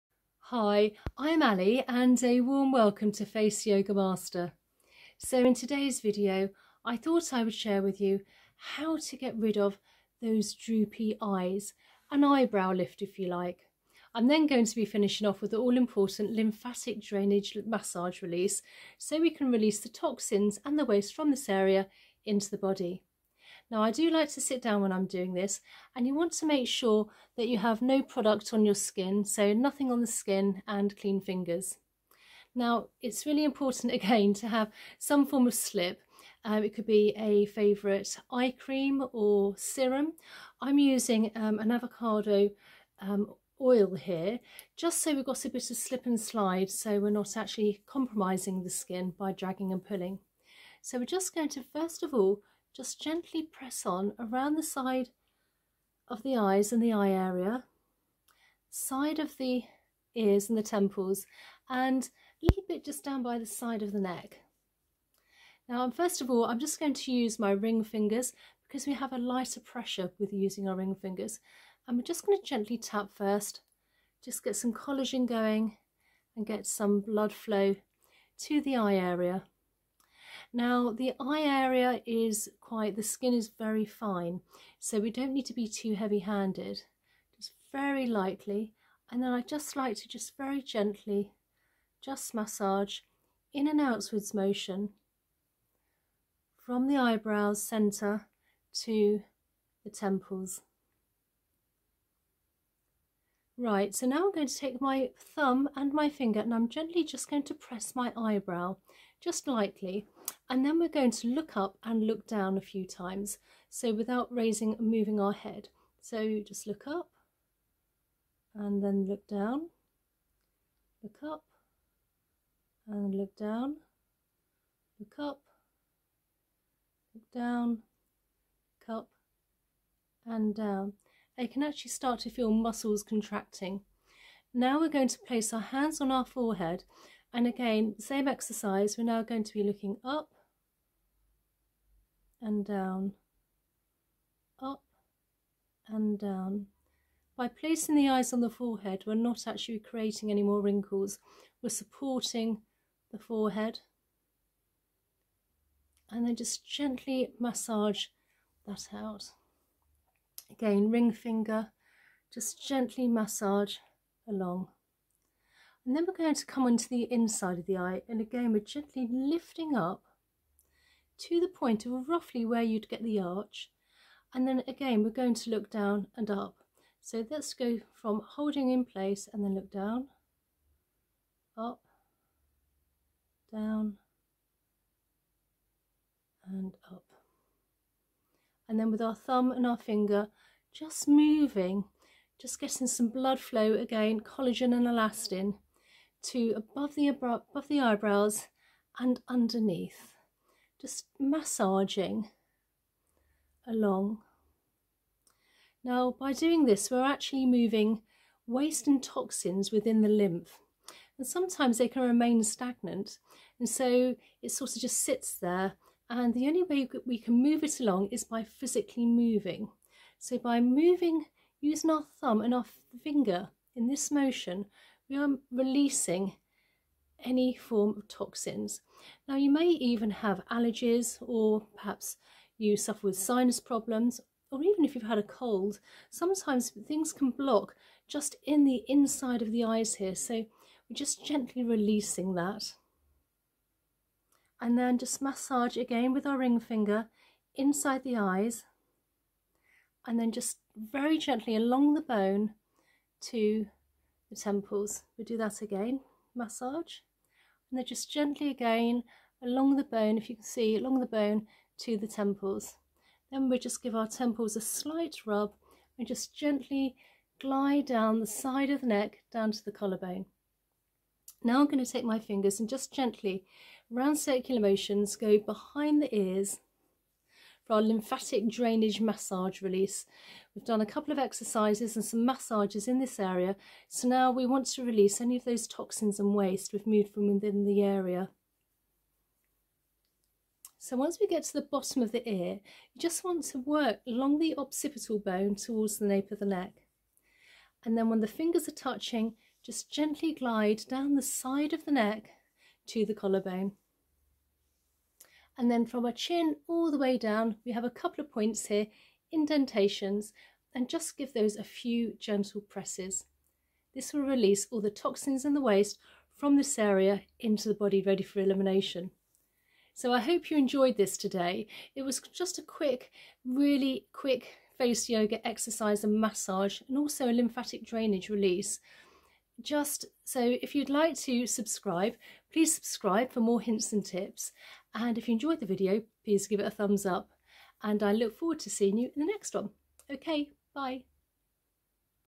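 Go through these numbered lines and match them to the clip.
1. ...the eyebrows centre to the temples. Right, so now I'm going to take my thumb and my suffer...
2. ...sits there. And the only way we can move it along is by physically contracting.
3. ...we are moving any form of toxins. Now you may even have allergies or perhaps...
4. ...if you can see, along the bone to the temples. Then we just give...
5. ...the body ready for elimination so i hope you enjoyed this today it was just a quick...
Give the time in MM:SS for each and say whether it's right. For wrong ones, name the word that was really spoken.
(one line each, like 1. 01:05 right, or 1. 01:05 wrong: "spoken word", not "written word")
1. 01:36 wrong: "finger", not "suffer"
2. 03:35 wrong: "moving", not "contracting"
3. 03:45 wrong: "releasing", not "moving"
4. 04:20 right
5. 05:17 right.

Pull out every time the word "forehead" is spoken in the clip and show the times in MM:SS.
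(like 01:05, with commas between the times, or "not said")
02:16, 02:28, 02:33.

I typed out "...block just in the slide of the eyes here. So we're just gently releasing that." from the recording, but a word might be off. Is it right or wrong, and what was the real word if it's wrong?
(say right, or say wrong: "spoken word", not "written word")
wrong: "inside", not "slide".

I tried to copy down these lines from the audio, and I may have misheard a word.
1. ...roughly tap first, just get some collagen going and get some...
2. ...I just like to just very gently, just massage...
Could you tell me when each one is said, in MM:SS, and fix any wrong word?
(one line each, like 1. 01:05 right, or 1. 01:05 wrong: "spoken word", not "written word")
1. 01:12 wrong: "gently", not "roughly"
2. 01:29 right.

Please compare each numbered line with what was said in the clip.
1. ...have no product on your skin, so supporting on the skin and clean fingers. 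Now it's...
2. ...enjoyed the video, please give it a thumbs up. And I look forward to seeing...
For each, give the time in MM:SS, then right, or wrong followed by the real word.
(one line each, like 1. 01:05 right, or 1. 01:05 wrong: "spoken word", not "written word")
1. 00:27 wrong: "nothing", not "supporting"
2. 05:35 right.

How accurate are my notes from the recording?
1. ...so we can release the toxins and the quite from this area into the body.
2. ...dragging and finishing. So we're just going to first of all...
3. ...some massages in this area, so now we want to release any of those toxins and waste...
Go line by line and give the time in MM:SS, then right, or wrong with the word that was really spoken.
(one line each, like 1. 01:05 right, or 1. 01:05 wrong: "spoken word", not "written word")
1. 00:18 wrong: "waste", not "quite"
2. 00:49 wrong: "pulling", not "finishing"
3. 04:42 right.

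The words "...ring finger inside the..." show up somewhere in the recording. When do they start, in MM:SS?
04:06.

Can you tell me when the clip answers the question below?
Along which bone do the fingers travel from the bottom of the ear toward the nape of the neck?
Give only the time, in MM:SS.
04:54.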